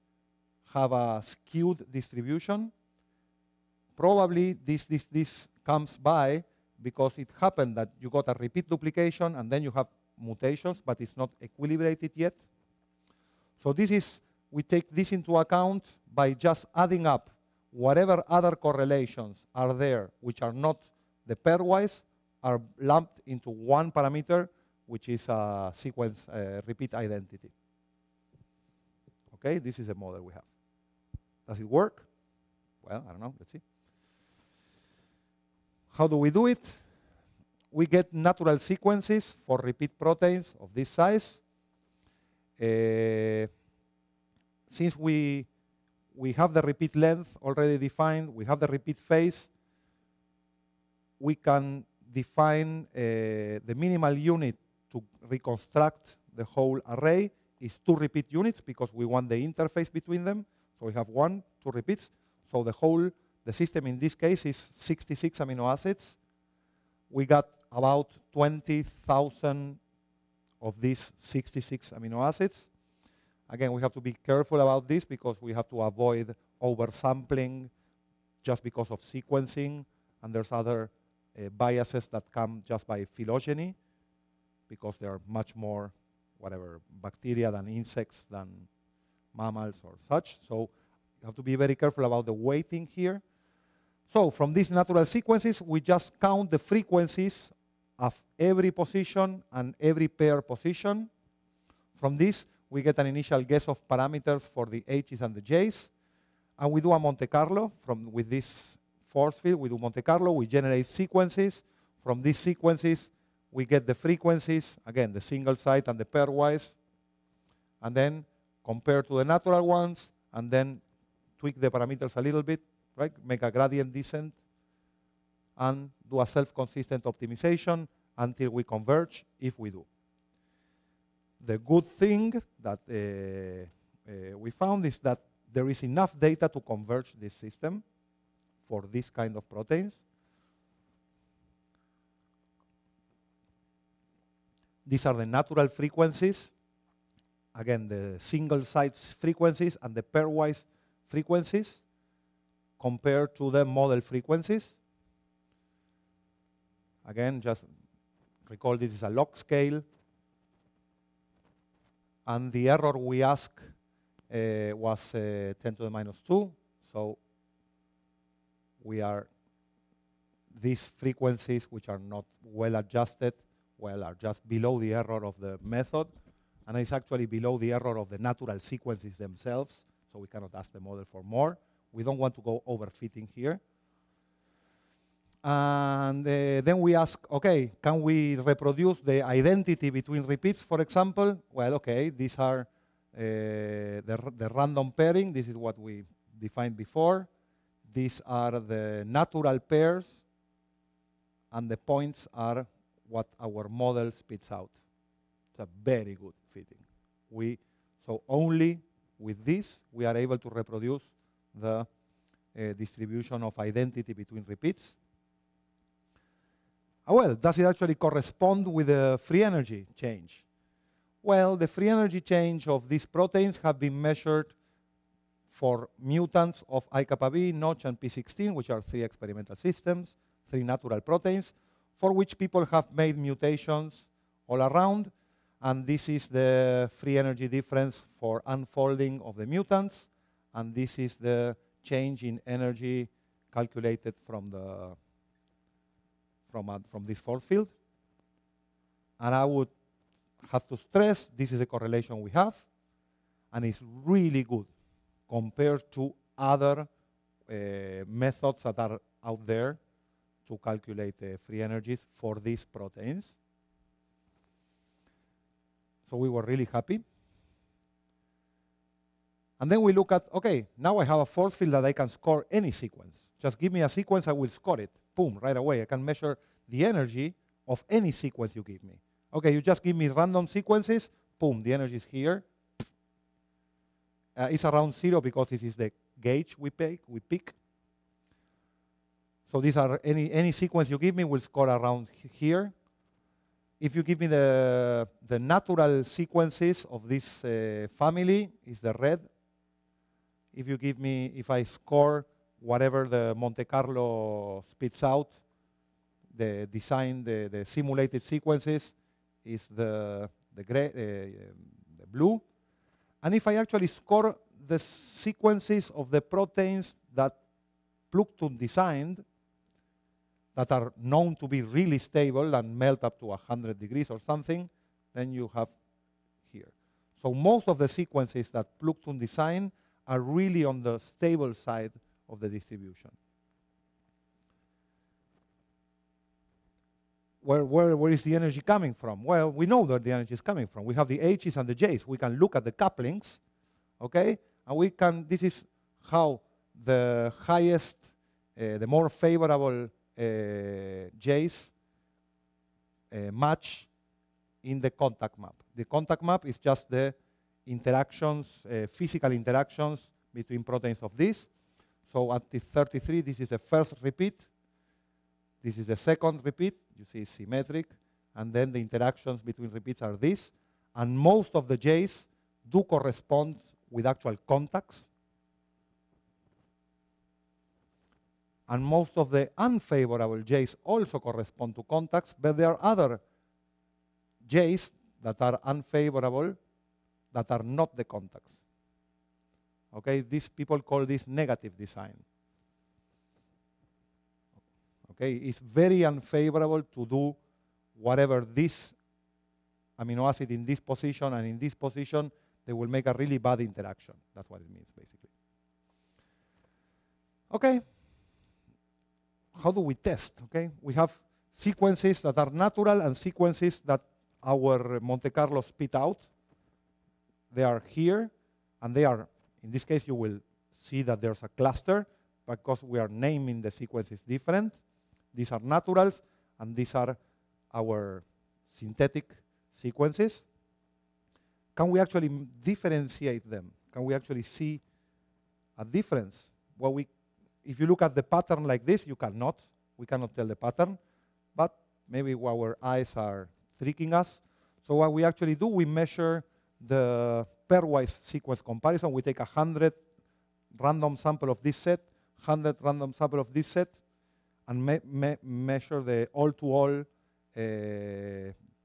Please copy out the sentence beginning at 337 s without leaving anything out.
Where, where, where is the energy coming from?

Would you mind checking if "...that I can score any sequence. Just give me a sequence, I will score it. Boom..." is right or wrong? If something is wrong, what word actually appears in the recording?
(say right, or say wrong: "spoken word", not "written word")
right.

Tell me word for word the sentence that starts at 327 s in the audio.
So most of the sequences that Plückthun design are really on the stable side of the distribution.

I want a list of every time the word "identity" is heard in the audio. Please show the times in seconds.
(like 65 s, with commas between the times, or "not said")
26 s, 189 s, 213 s.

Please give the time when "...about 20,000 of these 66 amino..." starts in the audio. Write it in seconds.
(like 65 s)
67 s.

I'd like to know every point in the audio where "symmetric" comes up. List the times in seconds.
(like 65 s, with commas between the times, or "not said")
367 s.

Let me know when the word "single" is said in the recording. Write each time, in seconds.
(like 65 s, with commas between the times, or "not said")
115 s, 148 s.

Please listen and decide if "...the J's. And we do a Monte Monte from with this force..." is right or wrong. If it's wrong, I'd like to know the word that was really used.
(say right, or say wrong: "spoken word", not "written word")
wrong: "Carlo", not "Monte".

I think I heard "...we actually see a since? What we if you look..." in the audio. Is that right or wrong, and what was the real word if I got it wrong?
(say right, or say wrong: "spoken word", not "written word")
wrong: "difference", not "since".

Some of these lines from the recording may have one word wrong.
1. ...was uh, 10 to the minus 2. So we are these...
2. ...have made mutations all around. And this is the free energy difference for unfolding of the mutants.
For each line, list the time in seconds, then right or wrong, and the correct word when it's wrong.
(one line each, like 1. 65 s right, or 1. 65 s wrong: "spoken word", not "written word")
1. 164 s right
2. 232 s right.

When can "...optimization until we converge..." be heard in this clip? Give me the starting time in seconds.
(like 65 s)
127 s.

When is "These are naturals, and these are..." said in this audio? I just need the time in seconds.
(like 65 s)
425 s.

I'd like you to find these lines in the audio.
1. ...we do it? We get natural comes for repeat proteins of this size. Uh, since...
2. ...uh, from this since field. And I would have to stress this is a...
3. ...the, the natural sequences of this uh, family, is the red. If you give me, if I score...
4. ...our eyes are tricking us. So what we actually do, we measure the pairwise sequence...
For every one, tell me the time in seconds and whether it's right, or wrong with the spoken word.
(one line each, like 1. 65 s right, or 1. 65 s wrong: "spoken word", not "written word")
1. 36 s wrong: "sequences", not "comes"
2. 246 s wrong: "force", not "since"
3. 294 s right
4. 442 s right.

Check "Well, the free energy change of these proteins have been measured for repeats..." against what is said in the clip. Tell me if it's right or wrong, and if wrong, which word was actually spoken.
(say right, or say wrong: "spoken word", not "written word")
wrong: "mutants", not "repeats".